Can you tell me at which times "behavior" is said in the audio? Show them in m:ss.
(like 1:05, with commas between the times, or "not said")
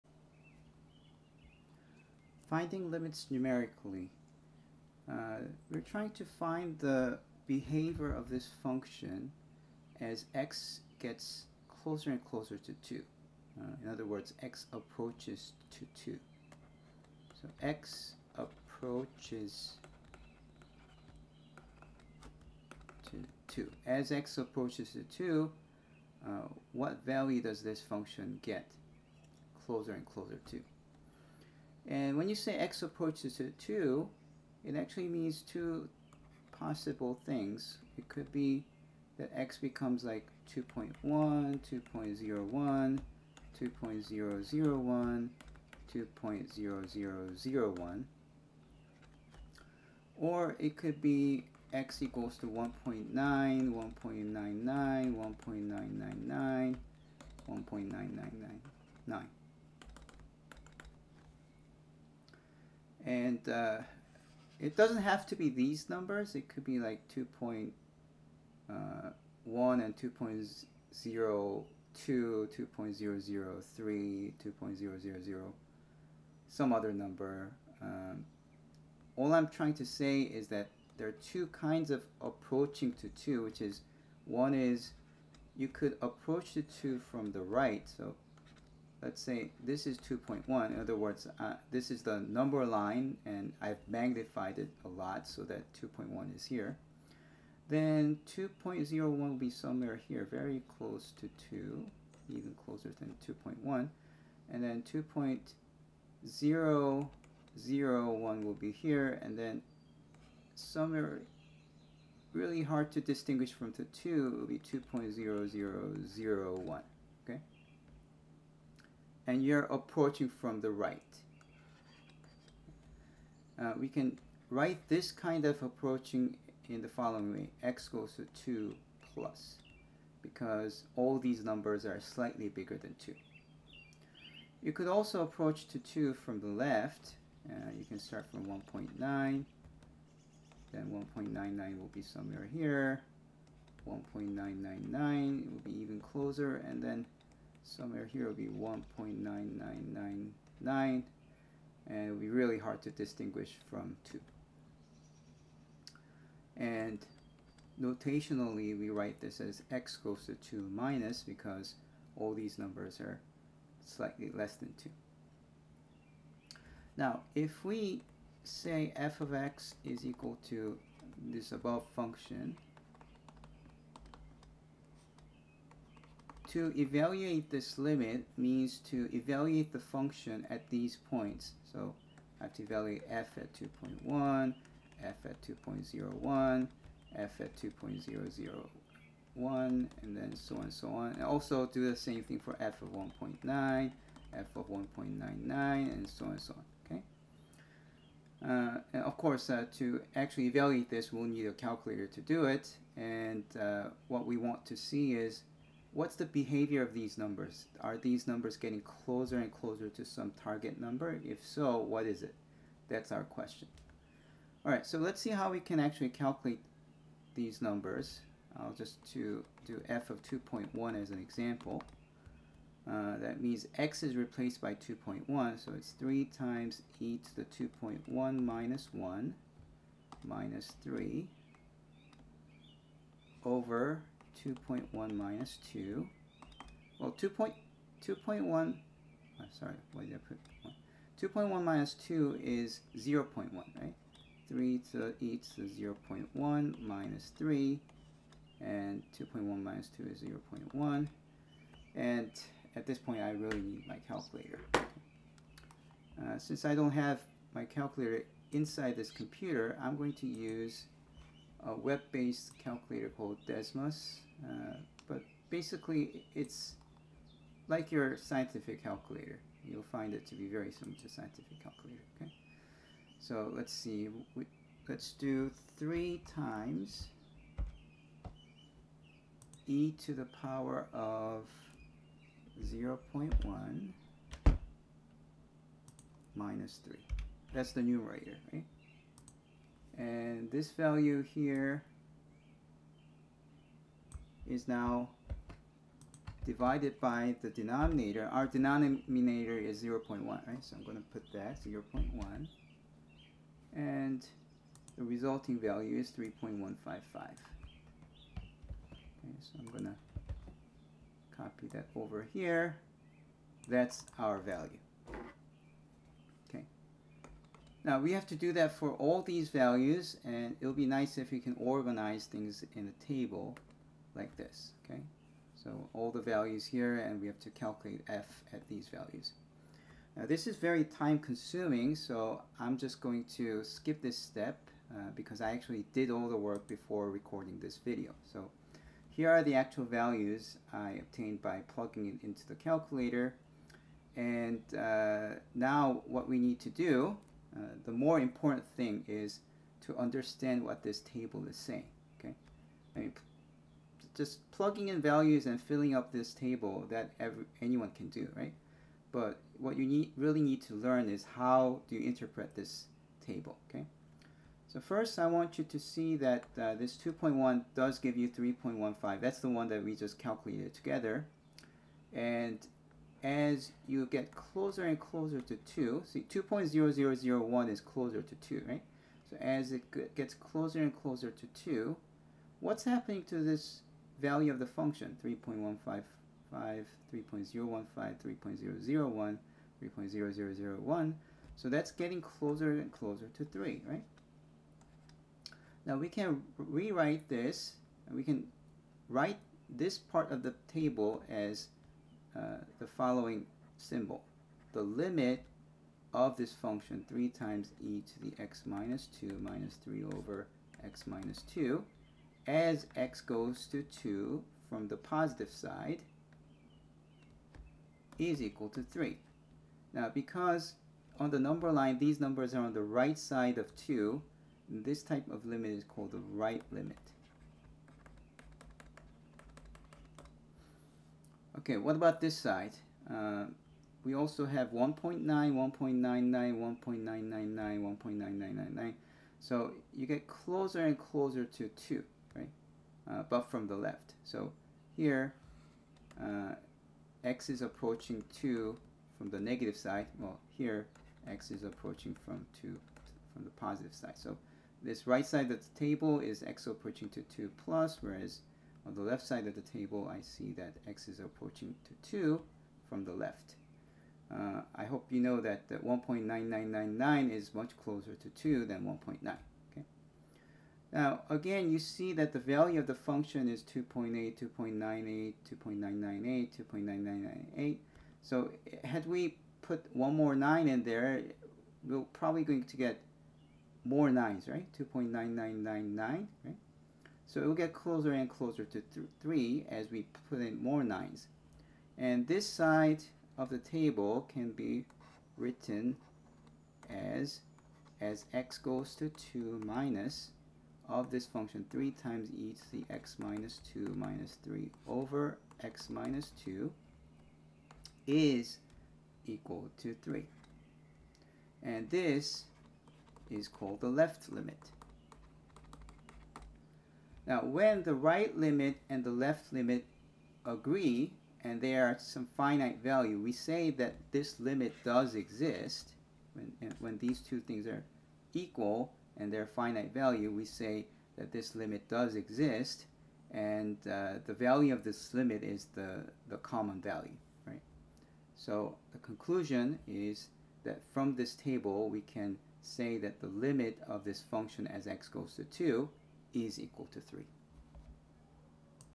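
0:07, 3:26.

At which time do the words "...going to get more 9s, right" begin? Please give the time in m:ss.
8:02.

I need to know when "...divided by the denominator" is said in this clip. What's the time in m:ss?
4:56.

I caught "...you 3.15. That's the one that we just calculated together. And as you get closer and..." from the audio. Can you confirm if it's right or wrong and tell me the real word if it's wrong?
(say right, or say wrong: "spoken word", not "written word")
right.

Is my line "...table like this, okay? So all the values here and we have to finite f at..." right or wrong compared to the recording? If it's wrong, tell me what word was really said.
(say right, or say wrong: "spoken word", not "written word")
wrong: "calculate", not "finite".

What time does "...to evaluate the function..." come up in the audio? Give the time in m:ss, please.
2:58.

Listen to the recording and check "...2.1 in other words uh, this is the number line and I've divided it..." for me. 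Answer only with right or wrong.
wrong.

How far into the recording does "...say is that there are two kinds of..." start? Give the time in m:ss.
1:19.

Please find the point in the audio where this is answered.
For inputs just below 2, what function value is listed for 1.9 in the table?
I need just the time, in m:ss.
7:53.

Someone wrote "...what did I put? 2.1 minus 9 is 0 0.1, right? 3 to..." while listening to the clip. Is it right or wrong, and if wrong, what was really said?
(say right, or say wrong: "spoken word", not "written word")
wrong: "2", not "9".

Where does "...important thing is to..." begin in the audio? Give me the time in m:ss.
5:48.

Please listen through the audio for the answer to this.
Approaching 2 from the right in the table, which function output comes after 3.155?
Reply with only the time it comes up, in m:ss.
6:26.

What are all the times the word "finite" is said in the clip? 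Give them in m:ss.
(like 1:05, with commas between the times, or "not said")
8:42, 8:49.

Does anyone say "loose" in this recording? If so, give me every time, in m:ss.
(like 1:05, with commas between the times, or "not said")
not said.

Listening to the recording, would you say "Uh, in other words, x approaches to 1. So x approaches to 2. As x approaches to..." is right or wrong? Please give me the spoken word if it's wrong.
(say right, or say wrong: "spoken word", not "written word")
wrong: "2", not "1".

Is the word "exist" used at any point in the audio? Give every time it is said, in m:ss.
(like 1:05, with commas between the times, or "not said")
8:45, 8:52.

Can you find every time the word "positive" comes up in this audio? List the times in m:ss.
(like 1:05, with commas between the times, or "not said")
6:54, 7:33.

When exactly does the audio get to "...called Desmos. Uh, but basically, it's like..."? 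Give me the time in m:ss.
4:23.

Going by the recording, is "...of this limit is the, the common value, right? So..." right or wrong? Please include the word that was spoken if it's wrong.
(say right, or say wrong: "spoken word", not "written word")
right.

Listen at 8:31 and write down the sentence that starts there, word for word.
And this is called the left limit.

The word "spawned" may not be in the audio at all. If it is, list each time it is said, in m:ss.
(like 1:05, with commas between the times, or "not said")
not said.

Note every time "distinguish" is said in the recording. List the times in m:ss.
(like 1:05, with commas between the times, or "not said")
1:53, 2:32.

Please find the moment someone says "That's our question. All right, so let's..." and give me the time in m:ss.
3:32.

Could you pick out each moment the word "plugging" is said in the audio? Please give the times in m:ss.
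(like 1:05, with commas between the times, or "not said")
5:41, 5:54.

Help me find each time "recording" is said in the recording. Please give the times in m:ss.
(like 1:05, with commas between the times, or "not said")
5:37.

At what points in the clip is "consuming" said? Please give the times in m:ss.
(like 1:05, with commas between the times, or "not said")
5:31.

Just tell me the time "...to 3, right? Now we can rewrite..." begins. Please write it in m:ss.
6:33.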